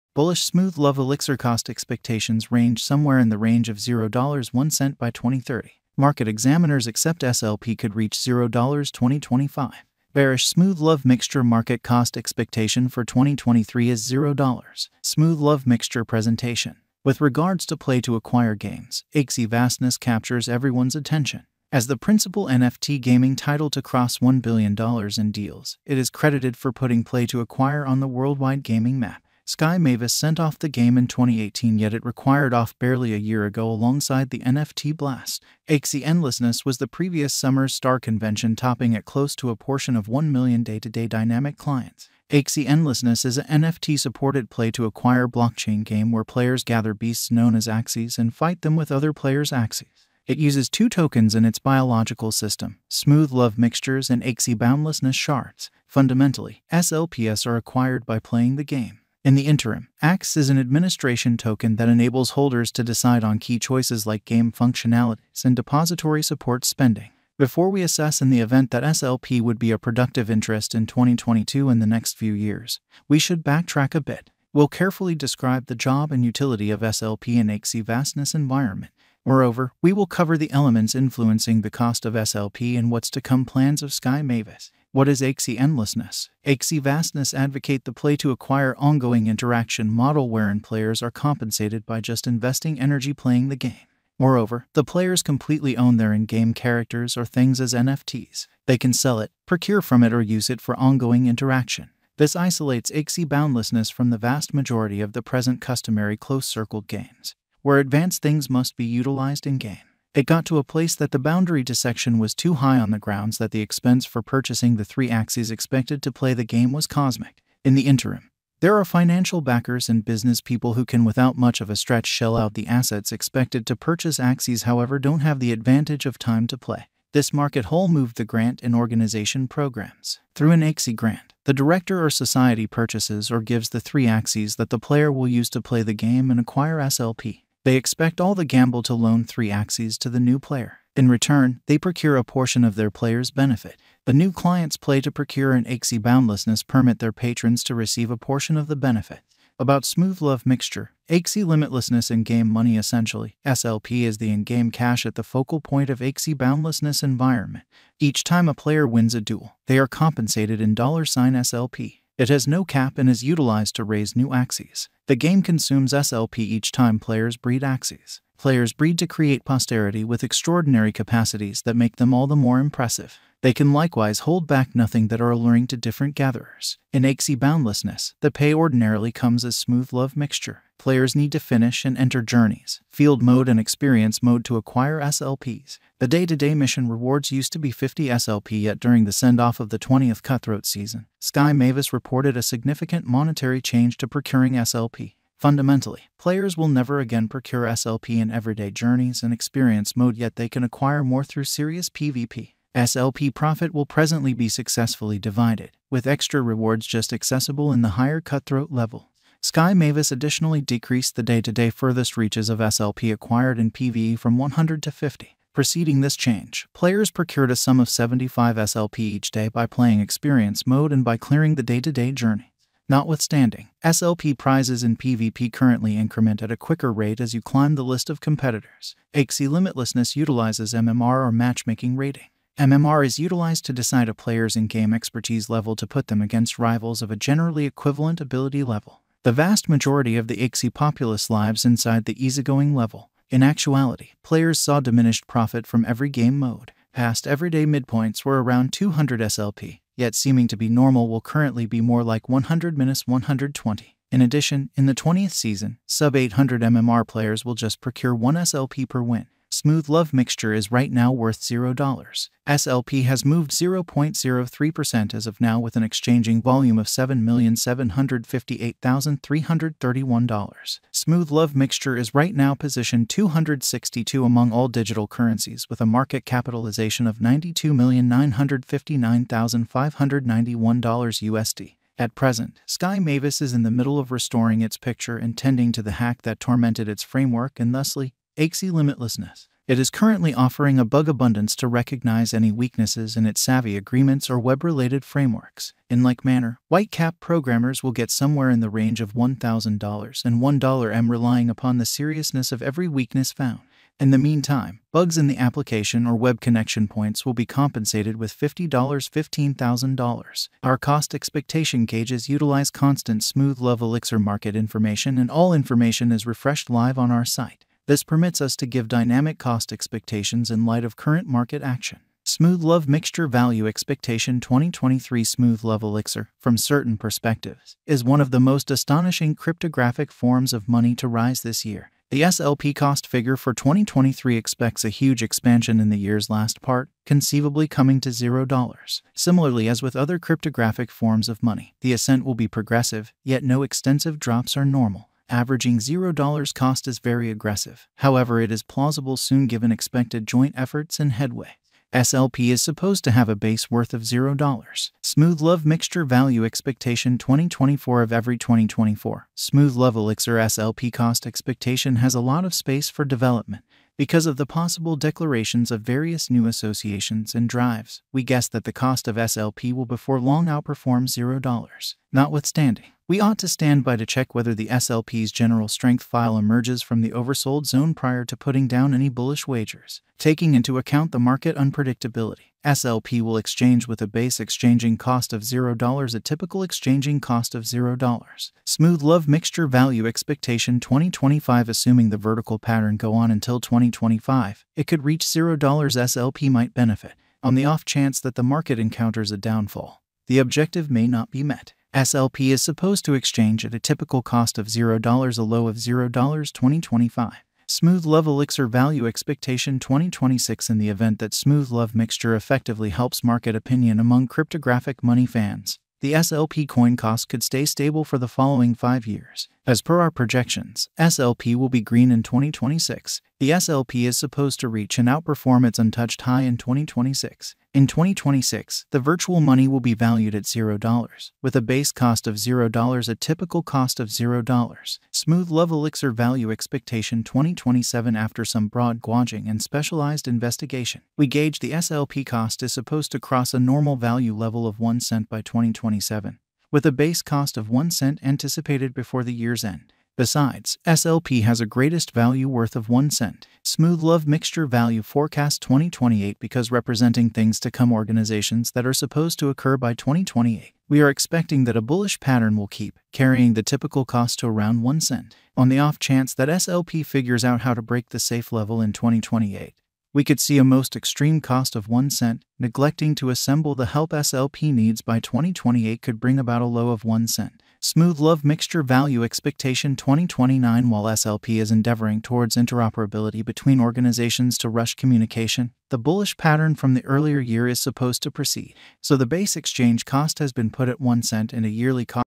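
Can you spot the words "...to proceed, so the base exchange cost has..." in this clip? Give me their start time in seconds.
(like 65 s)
488 s.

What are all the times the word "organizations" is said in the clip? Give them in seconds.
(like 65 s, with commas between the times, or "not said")
128 s, 457 s, 483 s.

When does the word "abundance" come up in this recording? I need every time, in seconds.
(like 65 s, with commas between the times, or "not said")
291 s.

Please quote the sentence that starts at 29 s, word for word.
Sky Mavis sent off the game in 2018, yet it required off barely a year ago alongside the NFT Blast.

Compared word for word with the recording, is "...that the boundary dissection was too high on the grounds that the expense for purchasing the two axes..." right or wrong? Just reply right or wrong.
wrong.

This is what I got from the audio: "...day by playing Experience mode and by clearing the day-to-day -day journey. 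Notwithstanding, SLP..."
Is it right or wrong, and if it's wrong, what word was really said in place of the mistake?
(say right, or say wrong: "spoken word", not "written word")
right.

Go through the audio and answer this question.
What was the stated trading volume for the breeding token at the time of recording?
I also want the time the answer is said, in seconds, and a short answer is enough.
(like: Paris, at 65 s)
$7,758,331, at 266 s.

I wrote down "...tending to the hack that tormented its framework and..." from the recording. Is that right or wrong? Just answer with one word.
right.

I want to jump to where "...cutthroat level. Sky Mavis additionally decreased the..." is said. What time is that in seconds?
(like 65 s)
208 s.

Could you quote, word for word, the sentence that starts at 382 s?
SLP will exchange with a base exchanging cost of $0, a typical exchanging cost of $0.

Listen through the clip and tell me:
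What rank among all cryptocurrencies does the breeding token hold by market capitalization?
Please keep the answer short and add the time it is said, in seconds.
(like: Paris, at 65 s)
262, at 273 s.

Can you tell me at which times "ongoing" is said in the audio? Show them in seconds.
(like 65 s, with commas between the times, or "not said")
88 s, 100 s.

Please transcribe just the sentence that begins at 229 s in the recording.
Axie Limitlessness utilizes MMR or matchmaking rating.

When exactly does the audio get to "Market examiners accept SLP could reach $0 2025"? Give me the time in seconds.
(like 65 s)
5 s.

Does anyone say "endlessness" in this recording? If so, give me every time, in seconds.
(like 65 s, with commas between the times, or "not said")
36 s, 42 s, 85 s.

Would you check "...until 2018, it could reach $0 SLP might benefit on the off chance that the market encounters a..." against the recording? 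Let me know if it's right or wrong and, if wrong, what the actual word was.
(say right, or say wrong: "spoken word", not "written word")
wrong: "2025", not "2018".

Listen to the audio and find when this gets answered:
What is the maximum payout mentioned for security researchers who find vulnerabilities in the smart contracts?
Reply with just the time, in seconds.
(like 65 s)
300 s.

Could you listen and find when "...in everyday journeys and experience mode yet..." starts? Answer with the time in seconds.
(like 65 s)
198 s.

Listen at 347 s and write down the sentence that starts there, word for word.
However, it is plausible soon given expected joint efforts and headway.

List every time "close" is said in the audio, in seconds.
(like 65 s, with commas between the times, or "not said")
39 s, 106 s.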